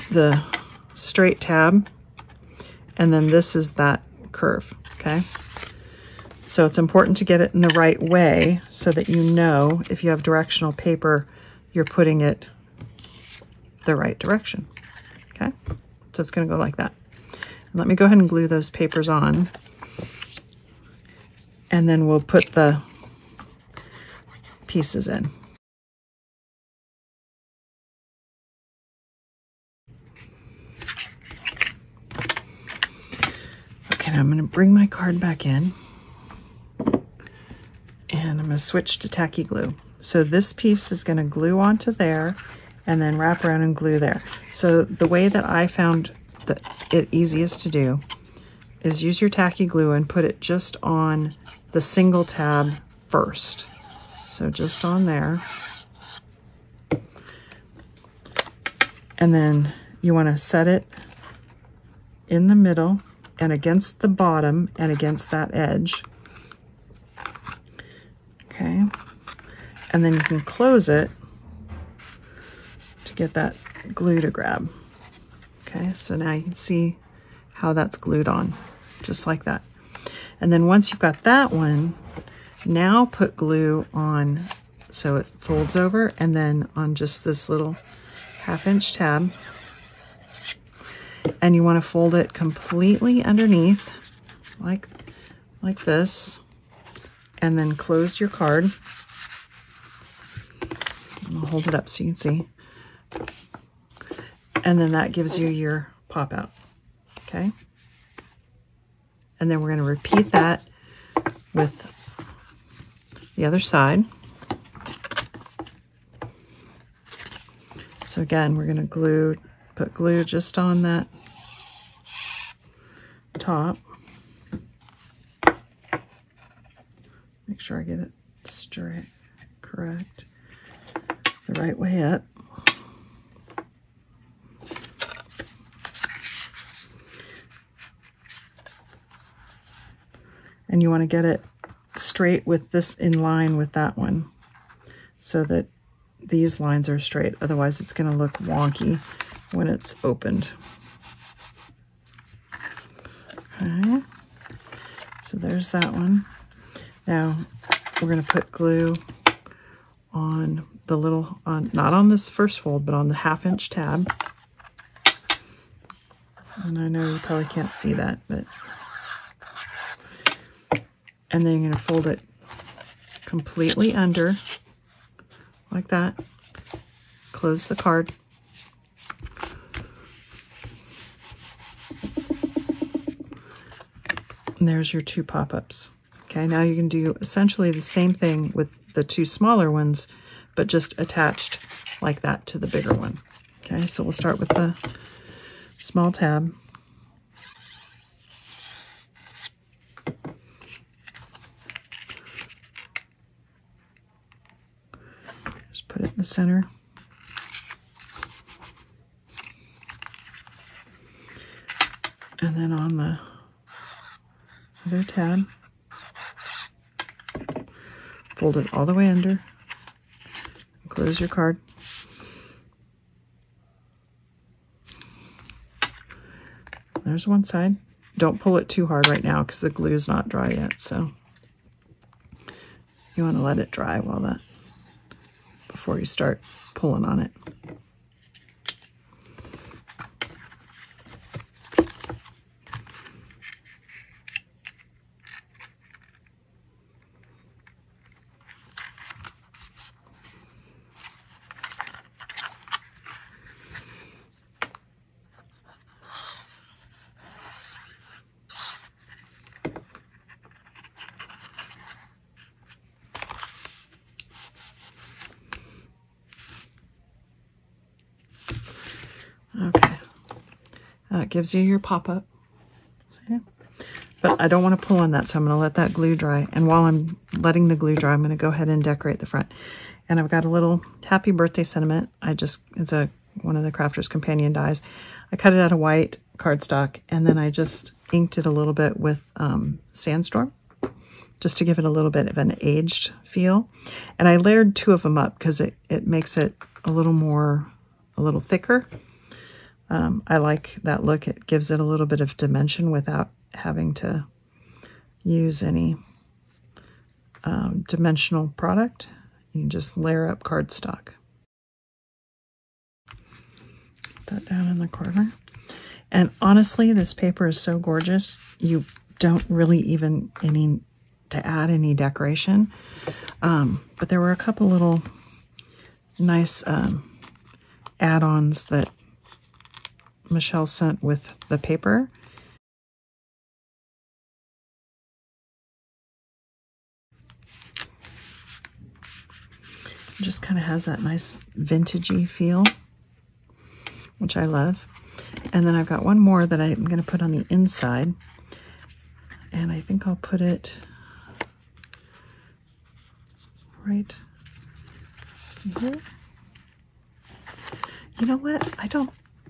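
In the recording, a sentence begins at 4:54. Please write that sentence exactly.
And I layered two of them up because it, it makes it a little more, a little thicker.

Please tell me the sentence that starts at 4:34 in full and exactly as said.
but I don't want to pull on that, so I'm going to let that glue dry.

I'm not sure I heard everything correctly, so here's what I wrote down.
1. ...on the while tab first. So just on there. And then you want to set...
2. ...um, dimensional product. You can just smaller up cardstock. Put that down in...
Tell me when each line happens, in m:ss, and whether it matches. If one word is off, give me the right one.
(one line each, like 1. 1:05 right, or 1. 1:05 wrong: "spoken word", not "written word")
1. 0:50 wrong: "single", not "while"
2. 5:07 wrong: "layer", not "smaller".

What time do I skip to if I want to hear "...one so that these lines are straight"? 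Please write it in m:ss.
2:23.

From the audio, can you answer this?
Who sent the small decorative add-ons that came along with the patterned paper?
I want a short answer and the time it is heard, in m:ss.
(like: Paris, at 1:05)
Michelle, at 5:30.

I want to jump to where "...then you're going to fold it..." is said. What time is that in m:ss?
2:51.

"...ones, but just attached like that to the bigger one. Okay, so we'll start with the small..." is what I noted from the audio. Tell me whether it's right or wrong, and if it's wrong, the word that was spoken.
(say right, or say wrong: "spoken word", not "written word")
right.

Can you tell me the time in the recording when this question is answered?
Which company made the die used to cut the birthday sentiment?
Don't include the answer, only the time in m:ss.
4:43.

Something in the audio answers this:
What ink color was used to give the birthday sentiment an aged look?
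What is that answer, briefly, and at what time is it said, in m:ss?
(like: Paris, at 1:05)
Sandstorm, at 4:49.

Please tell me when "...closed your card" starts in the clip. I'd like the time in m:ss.
1:37.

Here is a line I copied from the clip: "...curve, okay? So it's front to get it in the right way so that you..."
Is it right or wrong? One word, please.
wrong.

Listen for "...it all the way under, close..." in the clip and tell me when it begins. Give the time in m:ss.
3:38.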